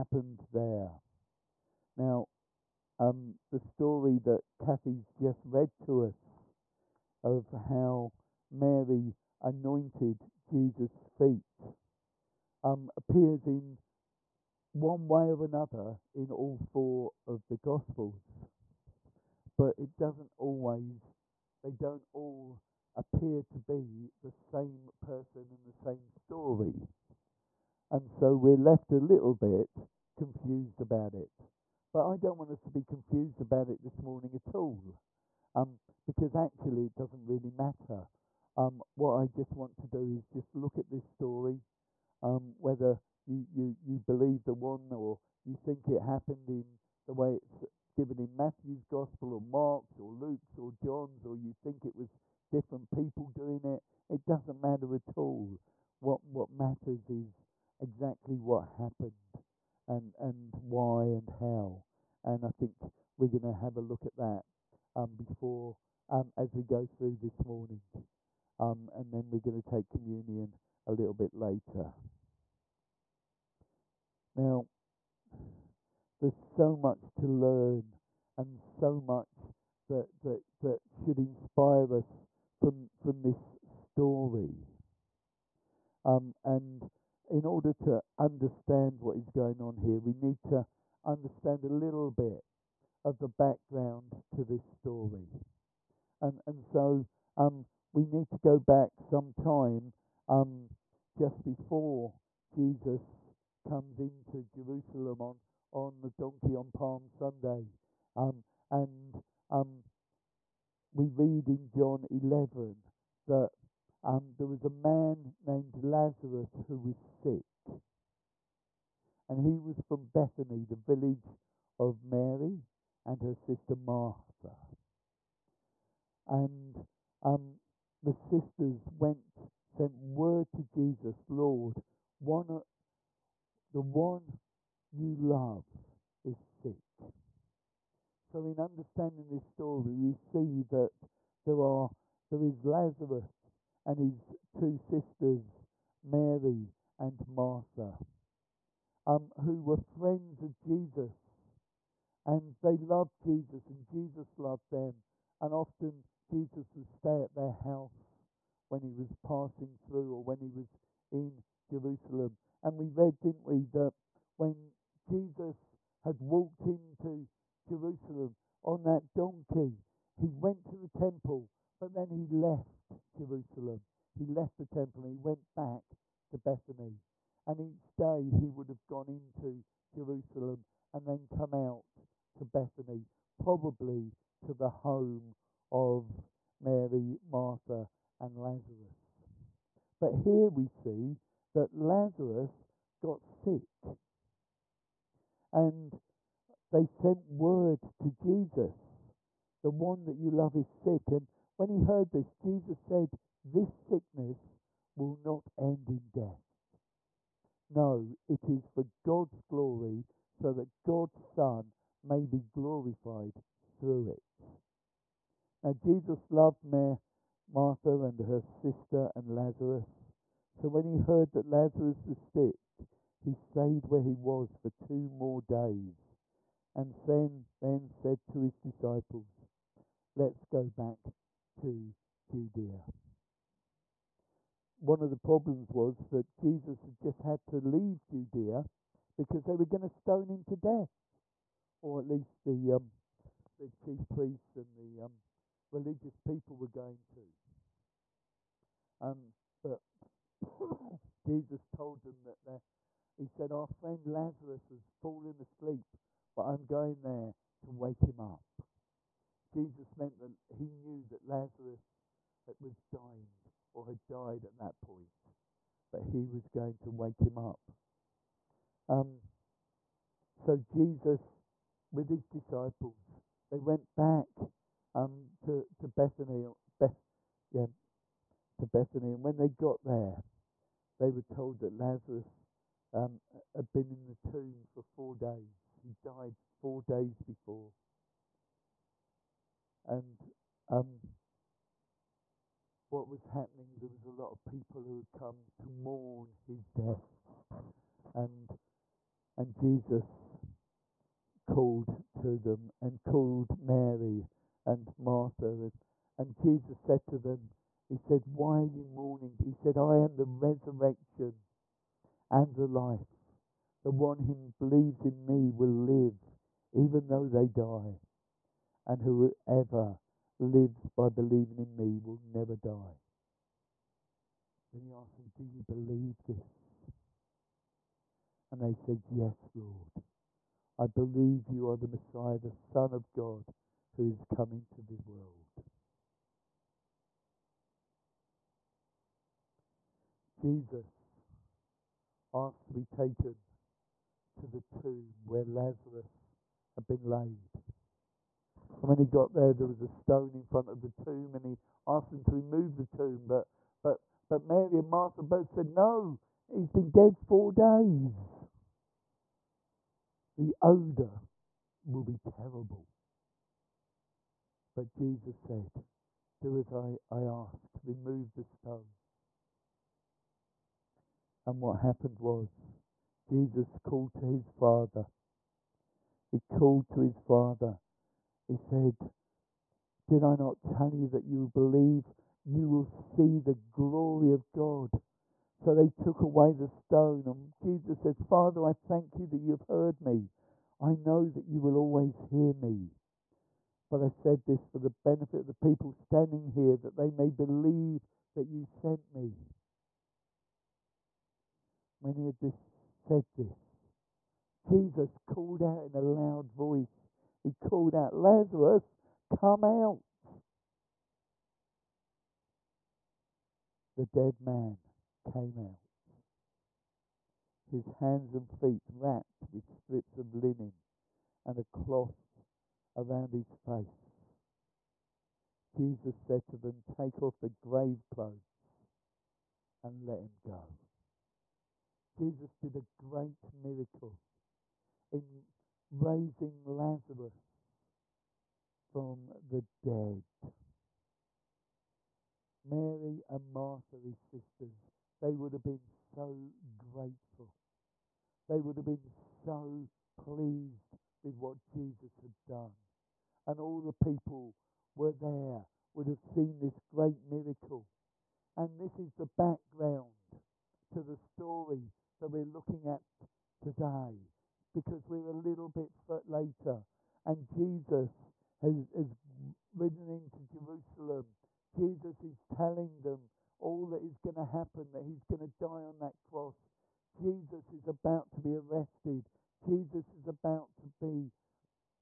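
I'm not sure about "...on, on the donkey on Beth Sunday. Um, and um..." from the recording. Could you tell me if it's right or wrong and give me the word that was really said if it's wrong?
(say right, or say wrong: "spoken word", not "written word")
wrong: "Palm", not "Beth".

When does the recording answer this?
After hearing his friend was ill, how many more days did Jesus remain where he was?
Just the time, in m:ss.
3:44.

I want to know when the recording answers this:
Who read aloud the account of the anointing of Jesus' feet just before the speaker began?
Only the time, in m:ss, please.
0:04.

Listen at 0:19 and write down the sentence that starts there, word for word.
But it doesn't always, they don't all appear to be the same person and the same story.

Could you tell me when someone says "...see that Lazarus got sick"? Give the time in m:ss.
3:10.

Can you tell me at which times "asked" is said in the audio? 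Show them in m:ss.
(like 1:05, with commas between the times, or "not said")
5:24, 5:42, 5:51.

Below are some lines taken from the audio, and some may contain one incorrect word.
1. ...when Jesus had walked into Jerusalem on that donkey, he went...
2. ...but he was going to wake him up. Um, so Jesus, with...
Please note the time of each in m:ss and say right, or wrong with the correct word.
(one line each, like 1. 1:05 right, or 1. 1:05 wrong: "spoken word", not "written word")
1. 2:44 right
2. 4:25 right.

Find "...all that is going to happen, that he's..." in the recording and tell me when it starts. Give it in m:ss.
7:53.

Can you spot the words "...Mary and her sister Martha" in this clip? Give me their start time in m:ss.
2:02.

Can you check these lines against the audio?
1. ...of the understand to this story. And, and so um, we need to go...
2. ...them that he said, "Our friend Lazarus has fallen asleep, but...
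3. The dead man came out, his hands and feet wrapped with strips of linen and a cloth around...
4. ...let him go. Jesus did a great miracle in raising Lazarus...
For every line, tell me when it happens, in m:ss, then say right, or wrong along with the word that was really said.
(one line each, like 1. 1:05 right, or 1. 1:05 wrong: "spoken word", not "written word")
1. 1:33 wrong: "background", not "understand"
2. 4:12 right
3. 6:53 right
4. 7:10 right.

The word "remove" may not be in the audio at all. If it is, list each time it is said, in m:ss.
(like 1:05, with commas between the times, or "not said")
5:52, 6:07.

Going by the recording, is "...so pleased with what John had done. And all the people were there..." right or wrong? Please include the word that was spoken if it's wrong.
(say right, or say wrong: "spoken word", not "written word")
wrong: "Jesus", not "John".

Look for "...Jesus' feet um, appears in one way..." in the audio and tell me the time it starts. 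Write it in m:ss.
0:10.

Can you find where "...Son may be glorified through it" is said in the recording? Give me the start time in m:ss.
3:31.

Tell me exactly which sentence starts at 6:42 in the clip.
When he had this, said this, Jesus called out in a loud voice, he called out, Lazarus, come out.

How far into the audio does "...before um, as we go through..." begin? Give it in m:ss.
1:05.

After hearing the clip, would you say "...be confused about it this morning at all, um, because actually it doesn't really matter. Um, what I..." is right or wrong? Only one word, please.
right.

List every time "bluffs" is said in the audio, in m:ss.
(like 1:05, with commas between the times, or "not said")
not said.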